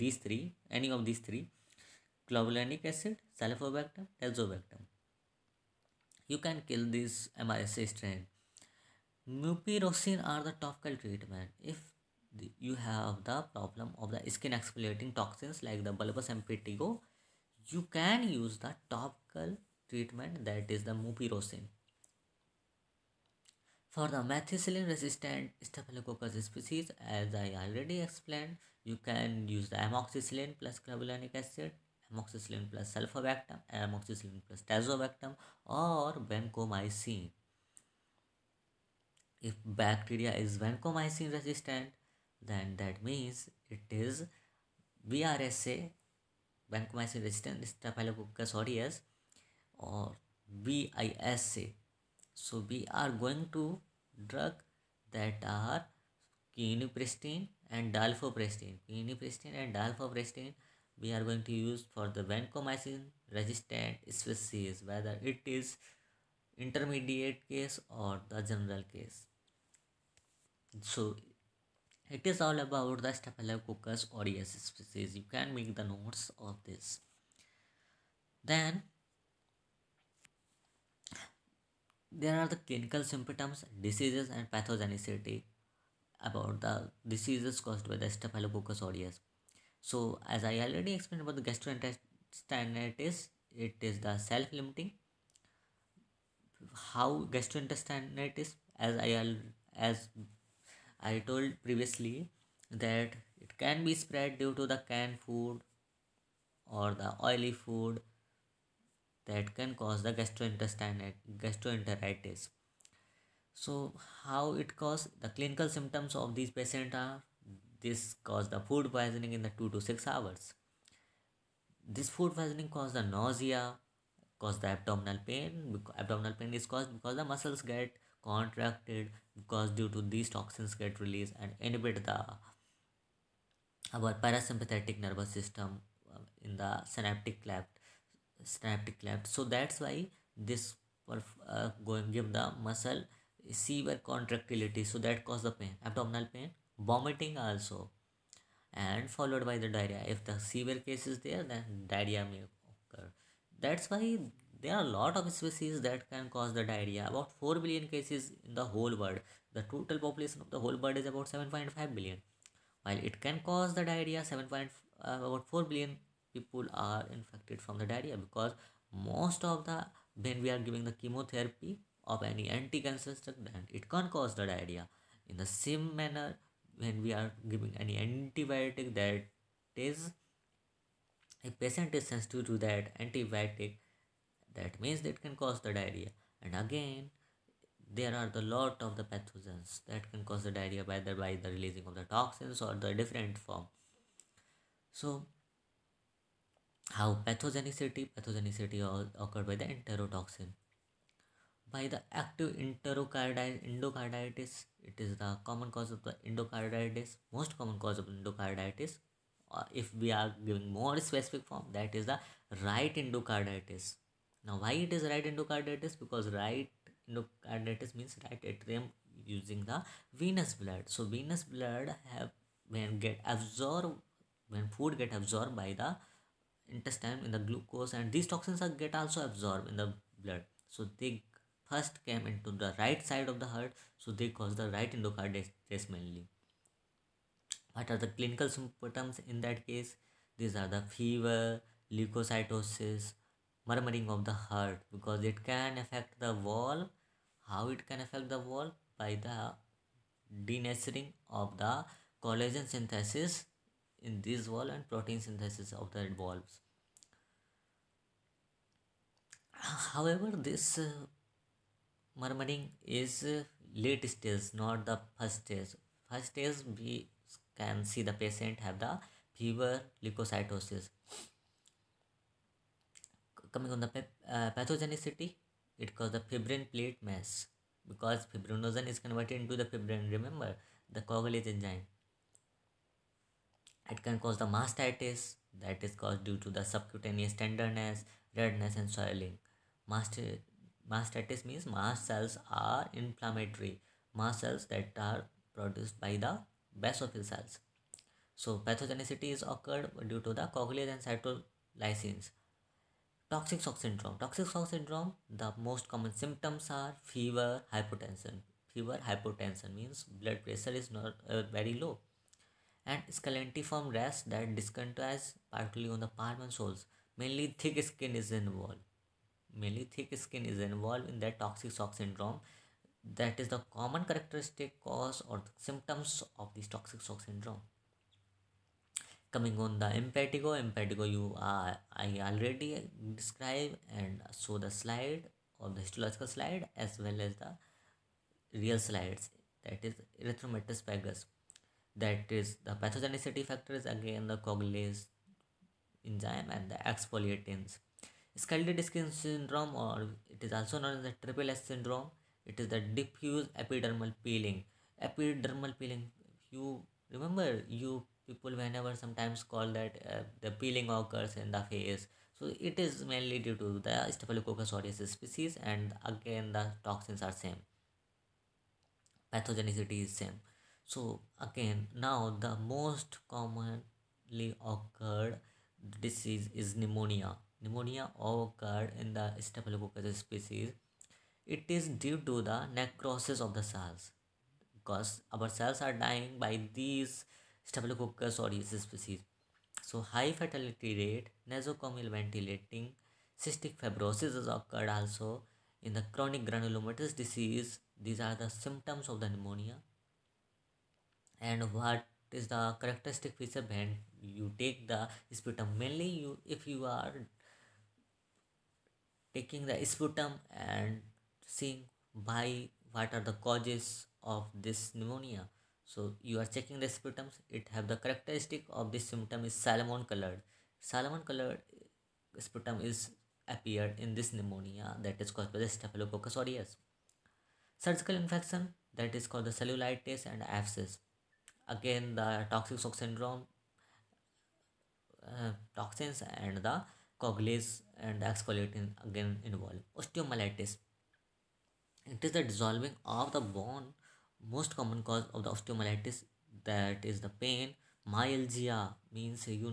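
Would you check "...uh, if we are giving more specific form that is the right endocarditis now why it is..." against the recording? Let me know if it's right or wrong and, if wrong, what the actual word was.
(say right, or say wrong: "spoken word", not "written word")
right.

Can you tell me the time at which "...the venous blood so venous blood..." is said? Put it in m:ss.
3:39.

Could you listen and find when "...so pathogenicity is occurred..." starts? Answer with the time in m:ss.
4:58.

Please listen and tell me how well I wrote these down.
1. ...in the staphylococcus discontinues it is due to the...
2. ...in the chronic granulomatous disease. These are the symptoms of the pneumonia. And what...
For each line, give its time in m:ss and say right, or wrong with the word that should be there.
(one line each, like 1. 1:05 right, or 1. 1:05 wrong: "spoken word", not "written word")
1. 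6:19 wrong: "species", not "discontinues"
2. 6:35 right.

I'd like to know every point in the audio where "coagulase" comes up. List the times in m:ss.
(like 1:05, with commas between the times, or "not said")
4:41, 5:00, 5:44, 7:17.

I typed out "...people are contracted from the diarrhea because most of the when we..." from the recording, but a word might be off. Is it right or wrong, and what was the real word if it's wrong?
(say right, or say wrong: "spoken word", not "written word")
wrong: "infected", not "contracted".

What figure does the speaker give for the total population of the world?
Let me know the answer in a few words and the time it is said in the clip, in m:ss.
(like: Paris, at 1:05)
7.5 billion, at 2:41.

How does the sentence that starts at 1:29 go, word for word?
So as I already explained about the gastroenteritis it is the self-limiting.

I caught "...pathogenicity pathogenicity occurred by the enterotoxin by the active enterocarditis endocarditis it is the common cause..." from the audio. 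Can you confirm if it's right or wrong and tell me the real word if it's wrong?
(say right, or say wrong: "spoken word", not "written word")
right.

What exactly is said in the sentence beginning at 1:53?
So how it cause the clinical symptoms of these patients are this cause the food poisoning in the two to six hours.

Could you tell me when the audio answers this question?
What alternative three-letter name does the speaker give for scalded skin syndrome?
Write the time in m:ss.
5:51.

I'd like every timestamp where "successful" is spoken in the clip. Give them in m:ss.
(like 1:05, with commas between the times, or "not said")
not said.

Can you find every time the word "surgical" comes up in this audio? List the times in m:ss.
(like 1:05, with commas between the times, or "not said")
7:07.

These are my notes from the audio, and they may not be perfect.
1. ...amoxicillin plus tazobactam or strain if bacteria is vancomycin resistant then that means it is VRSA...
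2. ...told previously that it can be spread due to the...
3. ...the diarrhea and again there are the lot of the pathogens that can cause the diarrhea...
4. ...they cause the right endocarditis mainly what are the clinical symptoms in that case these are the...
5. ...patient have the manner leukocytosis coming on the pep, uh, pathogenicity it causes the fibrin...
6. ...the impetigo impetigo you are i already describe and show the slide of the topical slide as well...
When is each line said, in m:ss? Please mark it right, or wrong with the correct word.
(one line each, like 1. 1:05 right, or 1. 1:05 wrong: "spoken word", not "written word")
1. 0:33 wrong: "vancomycin", not "strain"
2. 1:41 right
3. 3:05 right
4. 3:54 right
5. 4:28 wrong: "fever", not "manner"
6. 5:29 wrong: "histological", not "topical".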